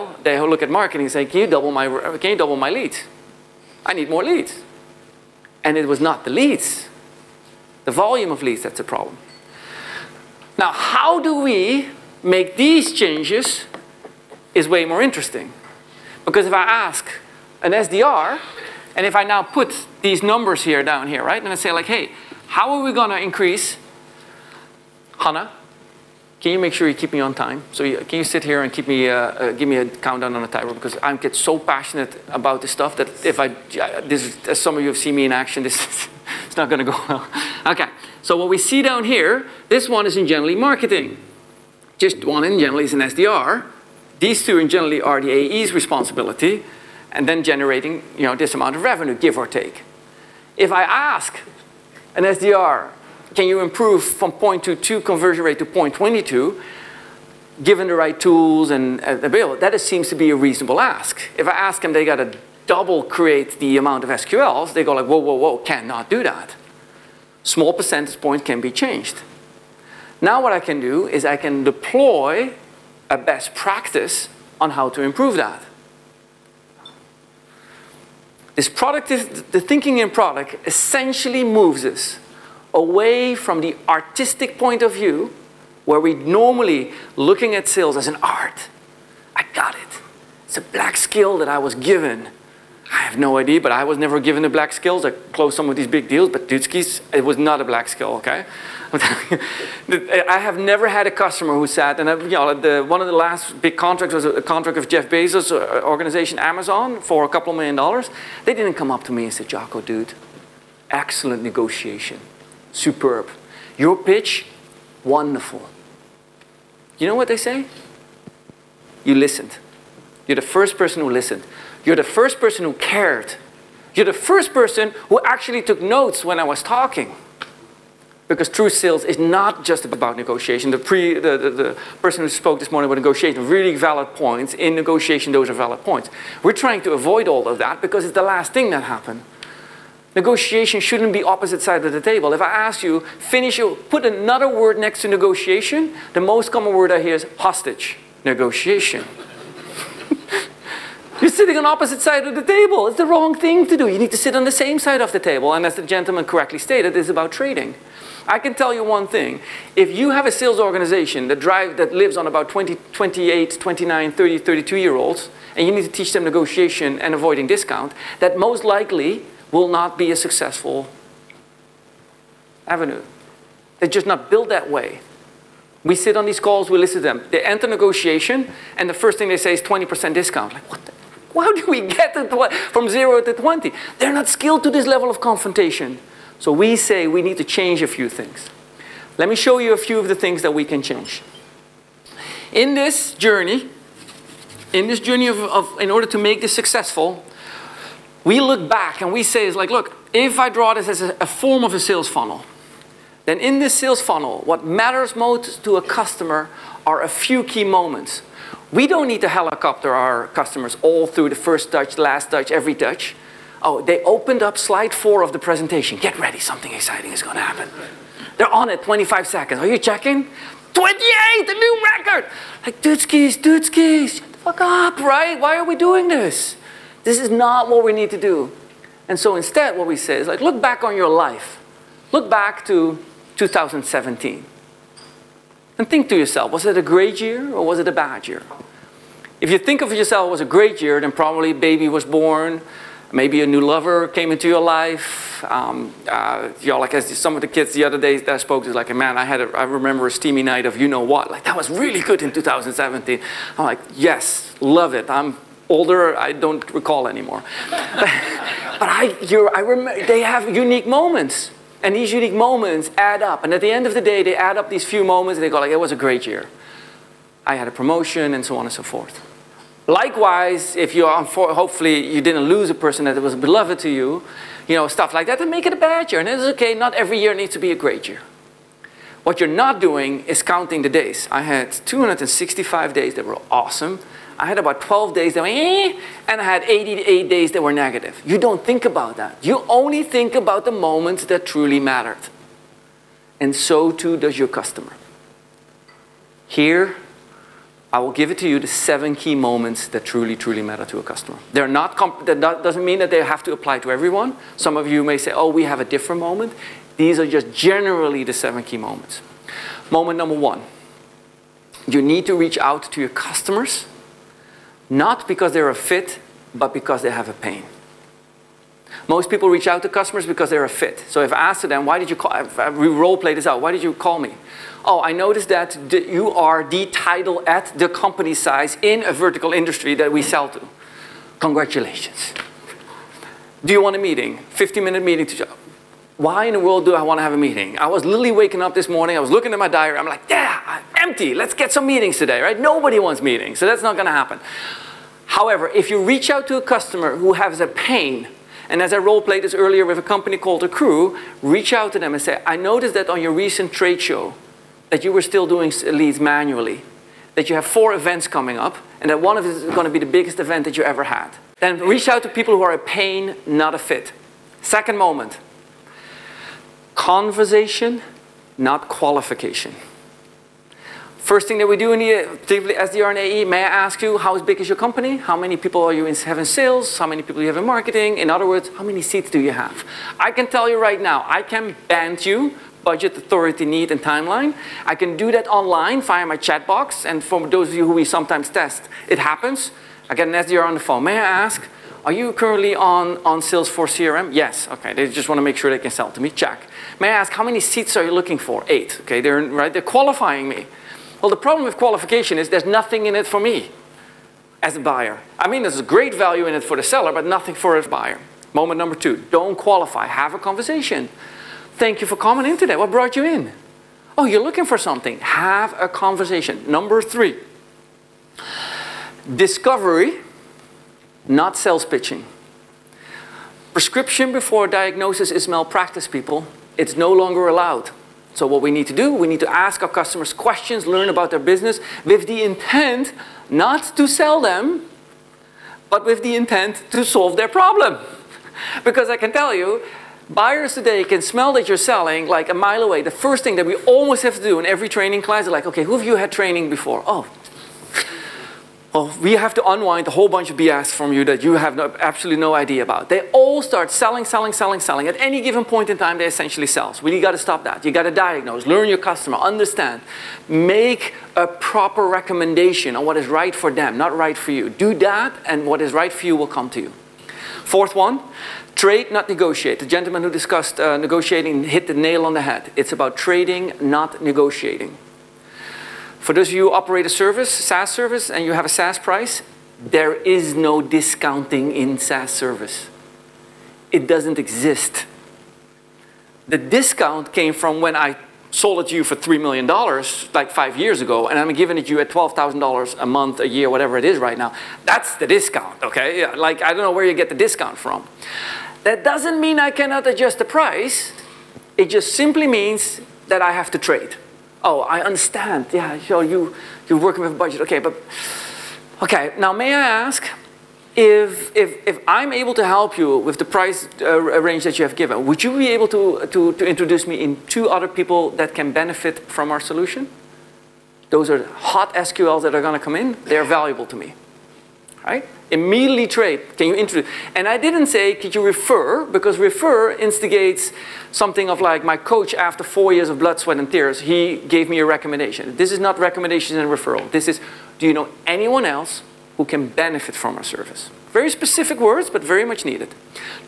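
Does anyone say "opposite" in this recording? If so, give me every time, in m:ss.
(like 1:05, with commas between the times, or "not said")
2:21, 2:31.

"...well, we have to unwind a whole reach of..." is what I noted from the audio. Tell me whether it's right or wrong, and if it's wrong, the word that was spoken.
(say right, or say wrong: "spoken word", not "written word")
wrong: "bunch", not "reach".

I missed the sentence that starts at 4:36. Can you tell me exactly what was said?
And it's okay, not every year needs to be a great year.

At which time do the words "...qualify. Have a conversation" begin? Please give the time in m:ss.
6:49.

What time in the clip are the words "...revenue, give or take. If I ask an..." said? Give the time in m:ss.
0:48.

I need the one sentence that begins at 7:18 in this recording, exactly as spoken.
because I can tell you, buyers today can smell that you're selling like a mile away.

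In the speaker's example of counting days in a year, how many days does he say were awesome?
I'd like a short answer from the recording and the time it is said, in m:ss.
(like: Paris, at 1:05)
265, at 4:41.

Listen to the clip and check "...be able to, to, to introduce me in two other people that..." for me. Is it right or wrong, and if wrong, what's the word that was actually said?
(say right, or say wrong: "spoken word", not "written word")
right.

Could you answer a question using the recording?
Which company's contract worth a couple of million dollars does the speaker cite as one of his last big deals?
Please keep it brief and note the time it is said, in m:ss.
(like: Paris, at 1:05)
Amazon, at 1:46.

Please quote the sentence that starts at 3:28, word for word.
We don't need to helicopter our customers all through the first touch, last touch, every touch.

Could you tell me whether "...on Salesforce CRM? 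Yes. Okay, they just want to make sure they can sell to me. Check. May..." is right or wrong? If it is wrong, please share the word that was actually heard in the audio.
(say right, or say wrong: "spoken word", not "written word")
right.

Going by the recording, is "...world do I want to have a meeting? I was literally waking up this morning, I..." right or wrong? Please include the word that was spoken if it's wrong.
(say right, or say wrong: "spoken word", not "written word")
right.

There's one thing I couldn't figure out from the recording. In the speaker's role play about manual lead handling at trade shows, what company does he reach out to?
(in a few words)
The Crew.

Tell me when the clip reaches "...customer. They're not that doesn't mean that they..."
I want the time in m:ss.
5:01.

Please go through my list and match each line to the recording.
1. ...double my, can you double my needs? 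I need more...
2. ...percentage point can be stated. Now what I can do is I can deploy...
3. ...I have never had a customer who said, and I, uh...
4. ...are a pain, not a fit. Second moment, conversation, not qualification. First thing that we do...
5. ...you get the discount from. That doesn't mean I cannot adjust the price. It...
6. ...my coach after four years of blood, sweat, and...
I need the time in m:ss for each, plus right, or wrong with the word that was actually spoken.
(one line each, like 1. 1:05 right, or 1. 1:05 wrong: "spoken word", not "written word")
1. 0:01 wrong: "leads", not "needs"
2. 1:07 wrong: "changed", not "stated"
3. 1:38 right
4. 6:02 right
5. 8:17 right
6. 8:51 right.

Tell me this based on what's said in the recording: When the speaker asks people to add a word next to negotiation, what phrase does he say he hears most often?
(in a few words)
hostage negotiation.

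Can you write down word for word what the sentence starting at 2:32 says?
It's the wrong thing to do.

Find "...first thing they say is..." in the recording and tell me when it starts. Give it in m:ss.
2:58.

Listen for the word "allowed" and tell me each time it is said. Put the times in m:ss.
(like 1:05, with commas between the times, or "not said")
7:07.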